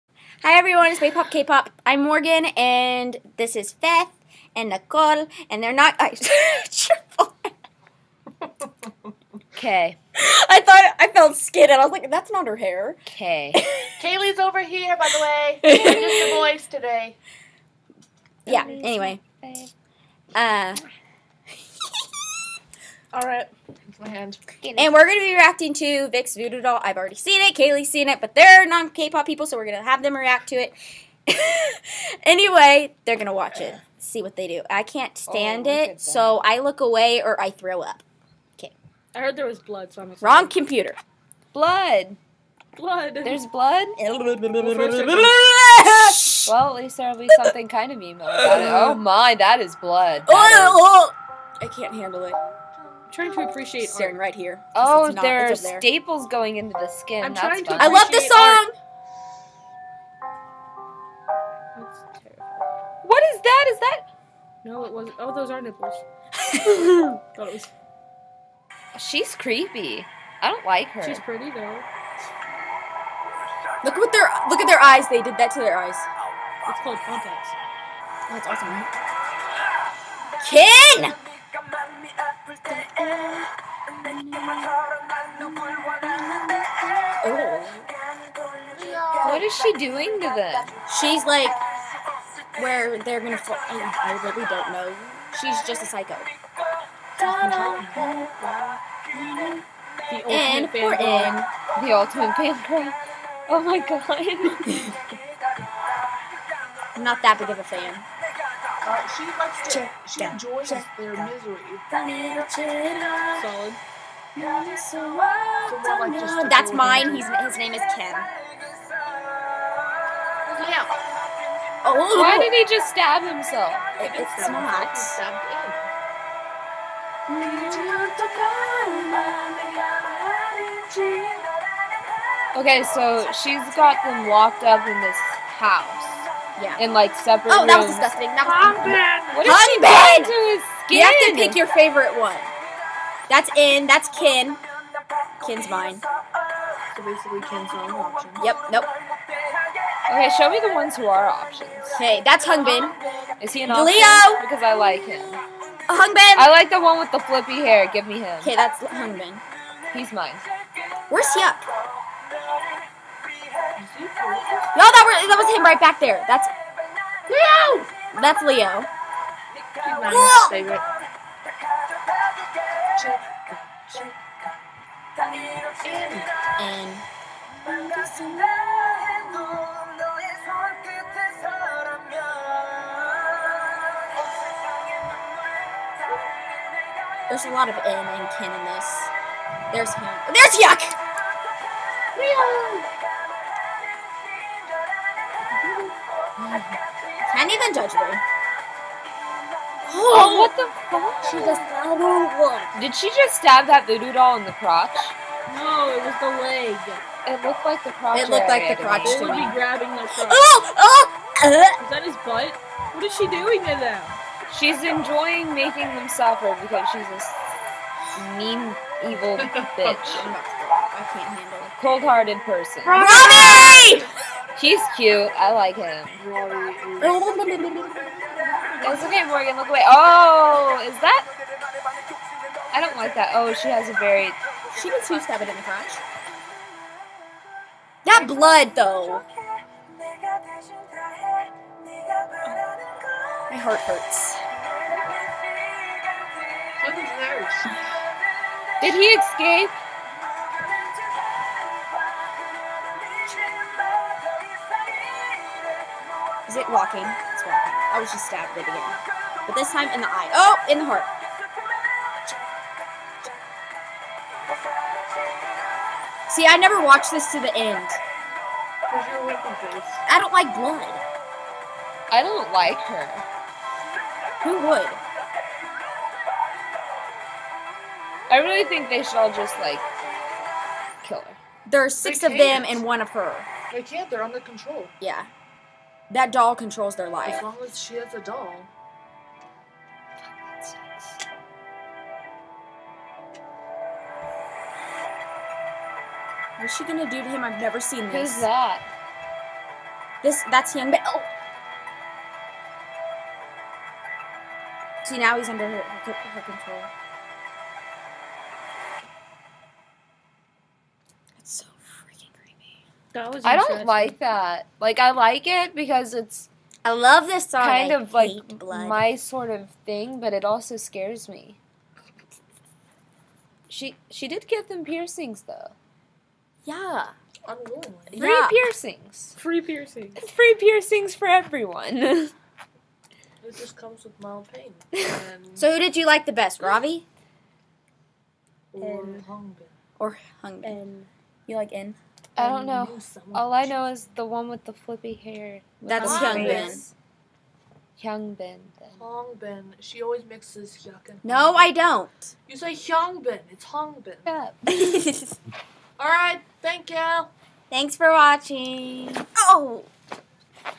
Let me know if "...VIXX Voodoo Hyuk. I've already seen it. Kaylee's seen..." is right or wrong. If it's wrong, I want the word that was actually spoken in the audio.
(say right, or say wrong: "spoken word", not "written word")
wrong: "Doll", not "Hyuk".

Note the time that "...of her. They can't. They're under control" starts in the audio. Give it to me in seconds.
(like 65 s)
282 s.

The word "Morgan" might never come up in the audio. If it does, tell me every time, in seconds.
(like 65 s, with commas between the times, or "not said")
2 s, 229 s.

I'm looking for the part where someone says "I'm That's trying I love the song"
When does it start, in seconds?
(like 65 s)
57 s.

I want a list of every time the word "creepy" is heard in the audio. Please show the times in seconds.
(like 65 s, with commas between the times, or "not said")
69 s.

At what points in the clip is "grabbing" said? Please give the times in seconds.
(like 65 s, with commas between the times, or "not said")
209 s.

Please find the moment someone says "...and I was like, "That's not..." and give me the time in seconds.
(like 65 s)
11 s.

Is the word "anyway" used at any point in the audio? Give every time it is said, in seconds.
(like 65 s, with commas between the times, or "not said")
18 s, 32 s.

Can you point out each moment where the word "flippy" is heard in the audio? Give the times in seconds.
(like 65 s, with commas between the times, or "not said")
157 s, 344 s.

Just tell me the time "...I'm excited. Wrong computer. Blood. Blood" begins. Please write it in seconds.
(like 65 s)
40 s.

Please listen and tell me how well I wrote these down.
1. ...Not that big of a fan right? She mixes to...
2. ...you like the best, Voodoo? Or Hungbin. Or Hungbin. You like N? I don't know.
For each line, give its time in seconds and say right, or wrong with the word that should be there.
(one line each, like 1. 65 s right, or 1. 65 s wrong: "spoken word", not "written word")
1. 107 s wrong: "likes", not "mixes"
2. 335 s wrong: "Ravi", not "Voodoo".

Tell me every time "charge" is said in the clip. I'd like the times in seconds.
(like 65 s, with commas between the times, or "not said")
not said.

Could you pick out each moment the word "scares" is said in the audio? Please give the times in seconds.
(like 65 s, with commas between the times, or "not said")
320 s.